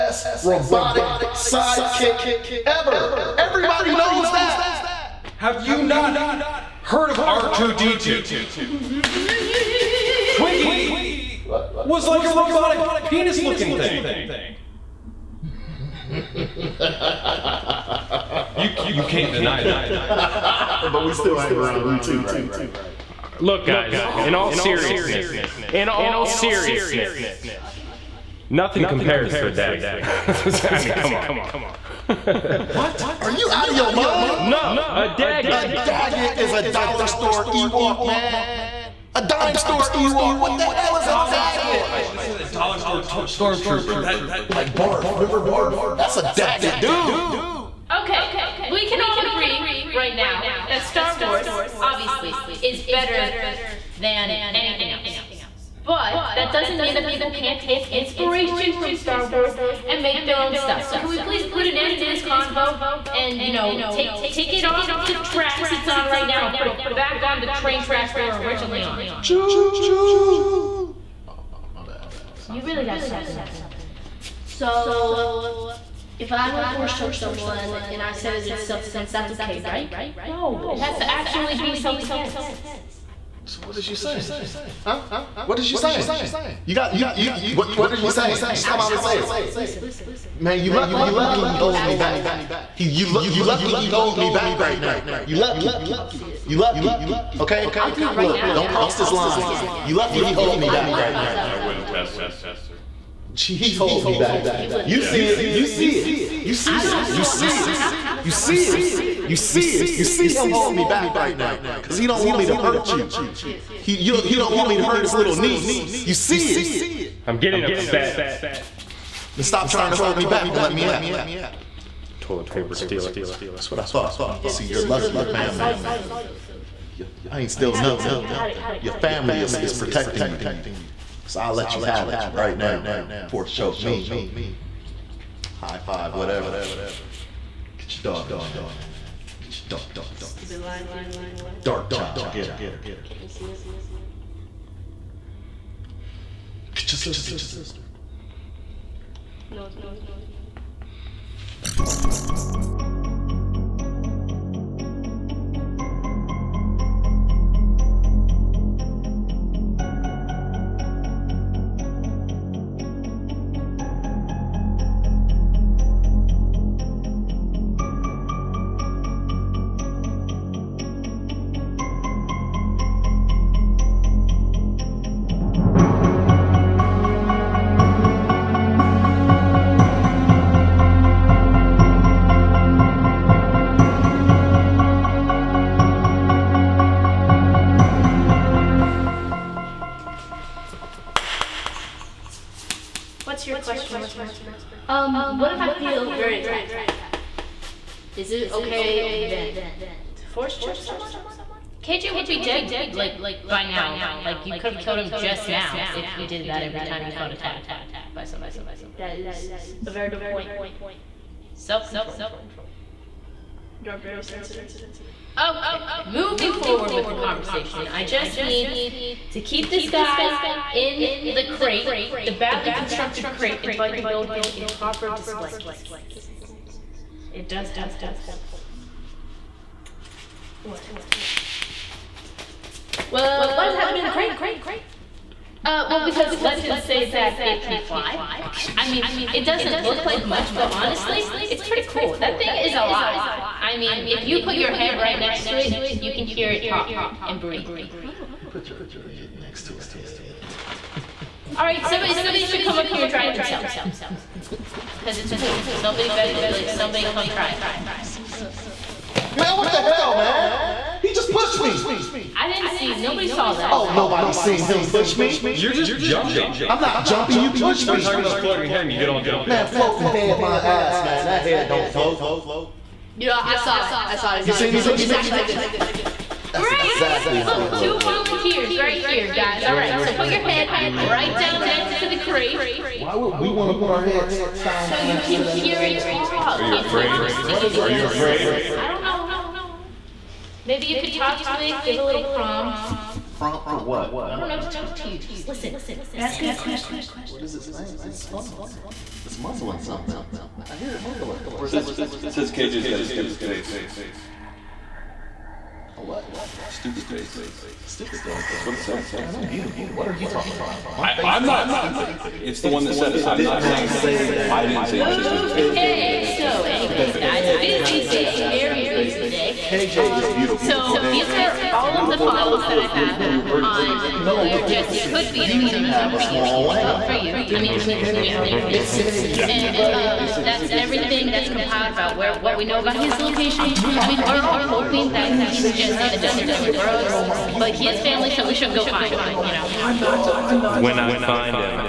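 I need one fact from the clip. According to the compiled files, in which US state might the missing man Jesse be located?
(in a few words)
Arizona.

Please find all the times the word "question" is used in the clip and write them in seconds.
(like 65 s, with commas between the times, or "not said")
193 s, 296 s.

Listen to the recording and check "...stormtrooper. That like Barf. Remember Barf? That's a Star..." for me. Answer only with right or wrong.
wrong.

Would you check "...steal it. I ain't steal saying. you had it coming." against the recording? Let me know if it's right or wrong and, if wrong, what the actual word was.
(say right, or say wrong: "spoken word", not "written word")
wrong: "nothing", not "saying".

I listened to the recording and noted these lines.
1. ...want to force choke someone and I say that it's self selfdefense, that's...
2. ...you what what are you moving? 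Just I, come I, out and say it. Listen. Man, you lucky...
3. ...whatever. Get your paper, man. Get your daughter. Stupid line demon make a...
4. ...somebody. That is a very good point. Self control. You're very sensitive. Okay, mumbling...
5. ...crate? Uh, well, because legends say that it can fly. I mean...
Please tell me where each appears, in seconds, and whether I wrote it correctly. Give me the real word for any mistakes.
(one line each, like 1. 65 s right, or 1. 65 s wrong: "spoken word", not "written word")
1. 76 s wrong: "defense", not "selfdefense"
2. 87 s wrong: "saying", not "moving"
3. 136 s wrong: "daughter", not "paper"
4. 208 s wrong: "moving", not "mumbling"
5. 234 s right.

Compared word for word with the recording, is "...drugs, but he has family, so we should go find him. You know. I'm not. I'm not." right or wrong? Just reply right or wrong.
right.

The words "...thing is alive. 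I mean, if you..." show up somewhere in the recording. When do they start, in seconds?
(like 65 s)
242 s.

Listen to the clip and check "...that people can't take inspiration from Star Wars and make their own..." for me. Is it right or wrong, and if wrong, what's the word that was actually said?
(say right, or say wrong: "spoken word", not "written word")
right.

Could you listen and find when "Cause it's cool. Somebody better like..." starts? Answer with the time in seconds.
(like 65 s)
255 s.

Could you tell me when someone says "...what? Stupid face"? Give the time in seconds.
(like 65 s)
306 s.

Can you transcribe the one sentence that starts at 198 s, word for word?
Is it okay then to force choke someone?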